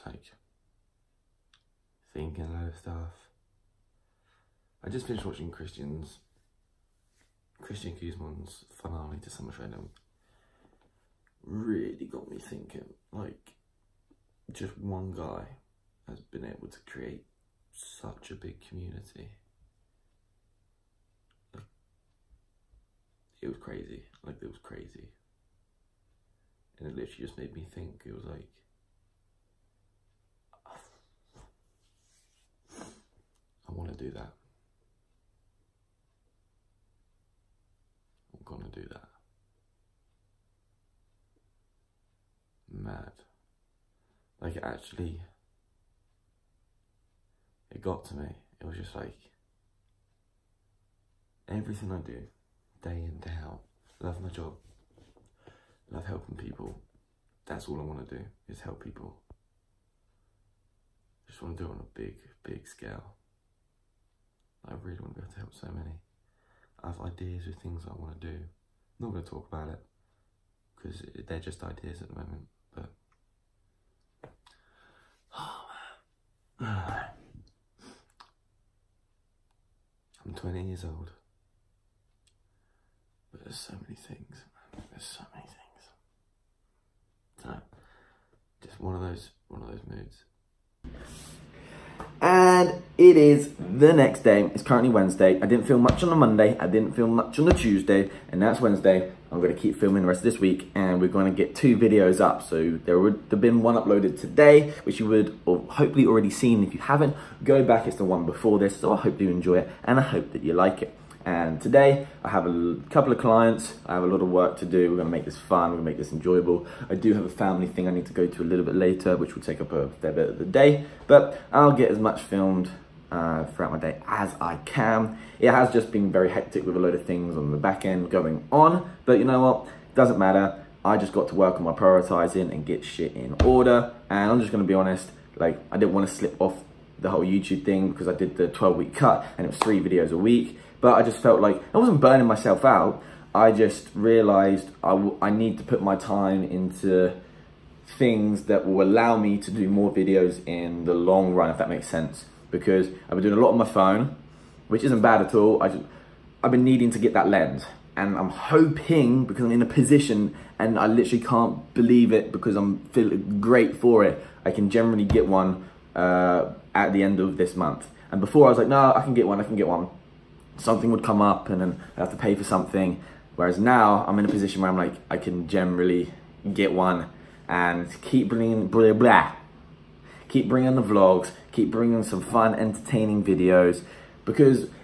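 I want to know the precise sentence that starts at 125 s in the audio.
It has just been very hectic with a load of things on the back end going on, but you know what?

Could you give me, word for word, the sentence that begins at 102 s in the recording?
So there would have been one uploaded today, which you would hopefully already seen.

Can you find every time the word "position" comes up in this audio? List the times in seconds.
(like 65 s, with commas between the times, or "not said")
159 s, 174 s.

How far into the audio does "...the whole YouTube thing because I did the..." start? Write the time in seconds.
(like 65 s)
136 s.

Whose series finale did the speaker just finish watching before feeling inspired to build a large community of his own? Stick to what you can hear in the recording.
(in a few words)
Christian Guzman.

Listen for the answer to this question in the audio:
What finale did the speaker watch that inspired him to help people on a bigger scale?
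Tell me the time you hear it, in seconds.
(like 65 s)
9 s.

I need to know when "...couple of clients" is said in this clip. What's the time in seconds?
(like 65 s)
112 s.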